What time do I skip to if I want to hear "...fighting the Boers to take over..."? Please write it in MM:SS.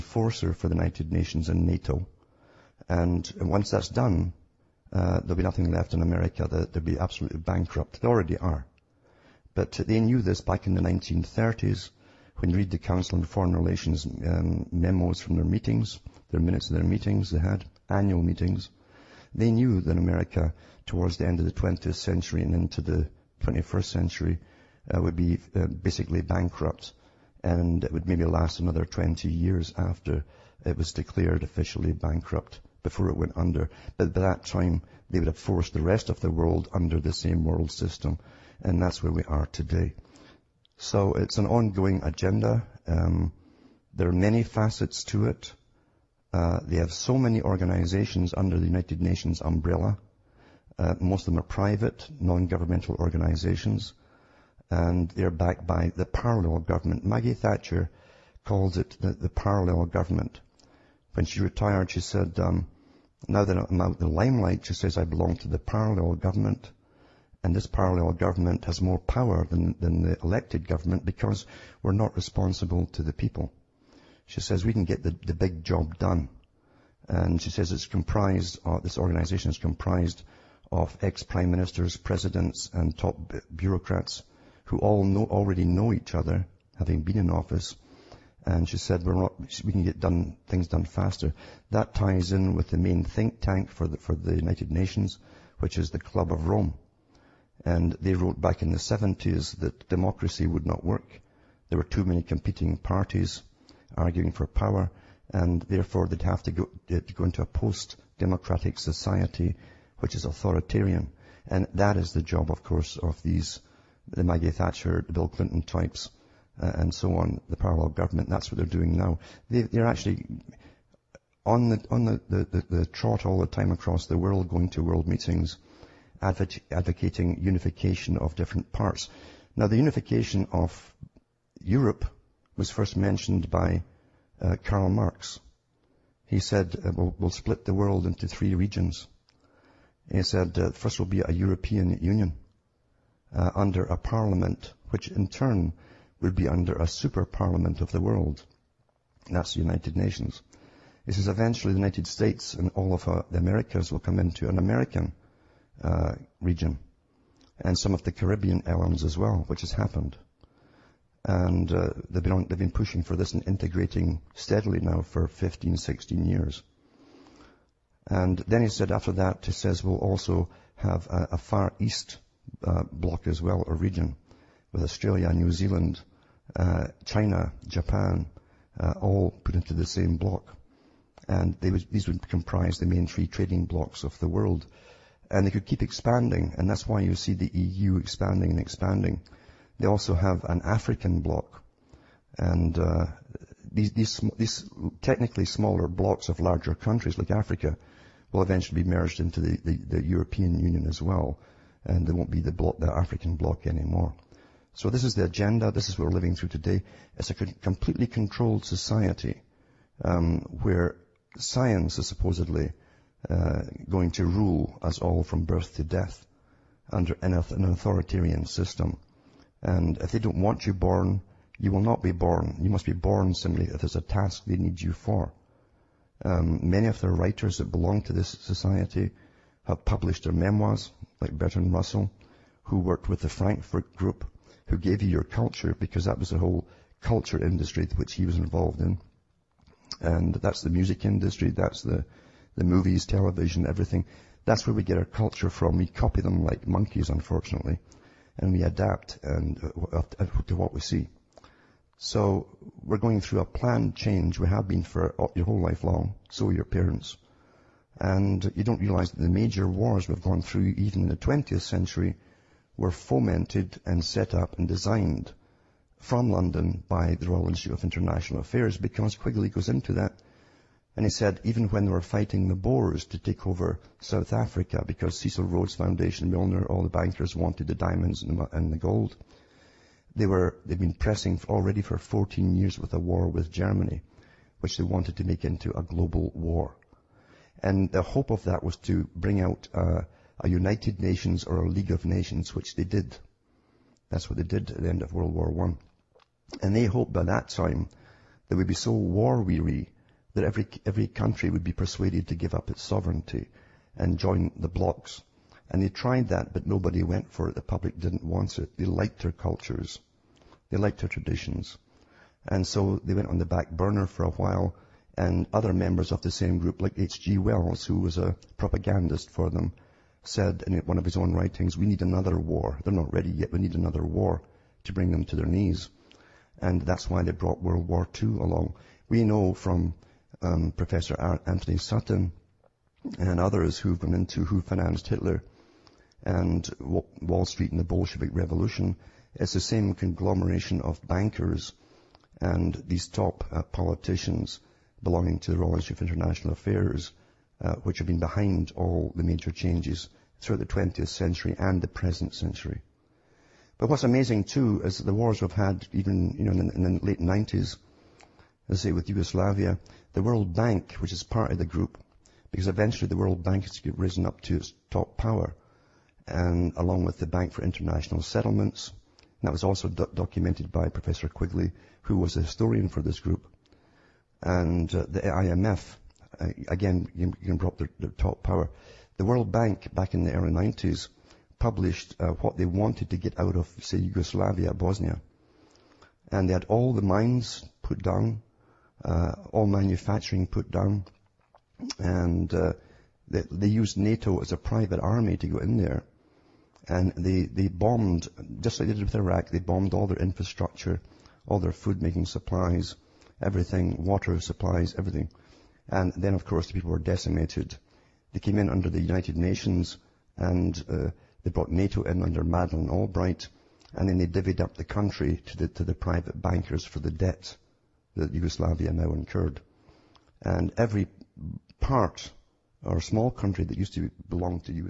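04:32.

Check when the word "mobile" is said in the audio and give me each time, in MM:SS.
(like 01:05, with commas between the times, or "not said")
not said.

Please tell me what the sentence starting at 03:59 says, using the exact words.
And that's the music industry, that's the the movies, television, everything.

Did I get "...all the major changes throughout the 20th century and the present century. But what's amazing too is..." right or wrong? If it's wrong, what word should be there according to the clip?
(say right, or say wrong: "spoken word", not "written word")
right.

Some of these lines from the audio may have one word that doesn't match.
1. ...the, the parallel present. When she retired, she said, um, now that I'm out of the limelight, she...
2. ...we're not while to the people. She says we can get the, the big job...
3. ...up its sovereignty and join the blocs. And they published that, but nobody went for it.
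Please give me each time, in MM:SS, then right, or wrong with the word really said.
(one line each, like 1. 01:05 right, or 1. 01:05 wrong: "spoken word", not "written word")
1. 00:58 wrong: "government", not "present"
2. 01:11 wrong: "responsible", not "while"
3. 05:02 wrong: "tried", not "published".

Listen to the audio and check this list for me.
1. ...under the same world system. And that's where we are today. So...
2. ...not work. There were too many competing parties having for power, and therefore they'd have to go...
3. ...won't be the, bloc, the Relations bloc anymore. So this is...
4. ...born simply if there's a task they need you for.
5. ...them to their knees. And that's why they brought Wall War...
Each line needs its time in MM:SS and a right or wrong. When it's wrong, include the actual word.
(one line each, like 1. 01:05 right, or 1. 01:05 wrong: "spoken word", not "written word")
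1. 00:36 right
2. 01:40 wrong: "arguing", not "having"
3. 03:22 wrong: "African", not "Relations"
4. 03:42 right
5. 05:25 wrong: "World", not "Wall".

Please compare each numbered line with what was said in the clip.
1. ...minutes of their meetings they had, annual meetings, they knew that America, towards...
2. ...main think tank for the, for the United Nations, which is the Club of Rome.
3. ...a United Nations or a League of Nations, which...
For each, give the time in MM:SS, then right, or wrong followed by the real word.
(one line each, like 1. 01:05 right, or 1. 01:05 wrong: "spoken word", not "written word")
1. 00:16 right
2. 01:32 right
3. 04:50 right.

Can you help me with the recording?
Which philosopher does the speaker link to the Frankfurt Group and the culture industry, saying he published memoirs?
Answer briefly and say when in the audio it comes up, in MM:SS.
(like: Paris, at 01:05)
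Bertrand Russell, at 03:51.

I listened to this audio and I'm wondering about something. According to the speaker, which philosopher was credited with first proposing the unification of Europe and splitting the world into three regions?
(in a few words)
Karl Marx.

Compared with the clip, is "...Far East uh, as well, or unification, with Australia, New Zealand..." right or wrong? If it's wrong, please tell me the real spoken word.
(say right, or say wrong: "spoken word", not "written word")
wrong: "region", not "unification".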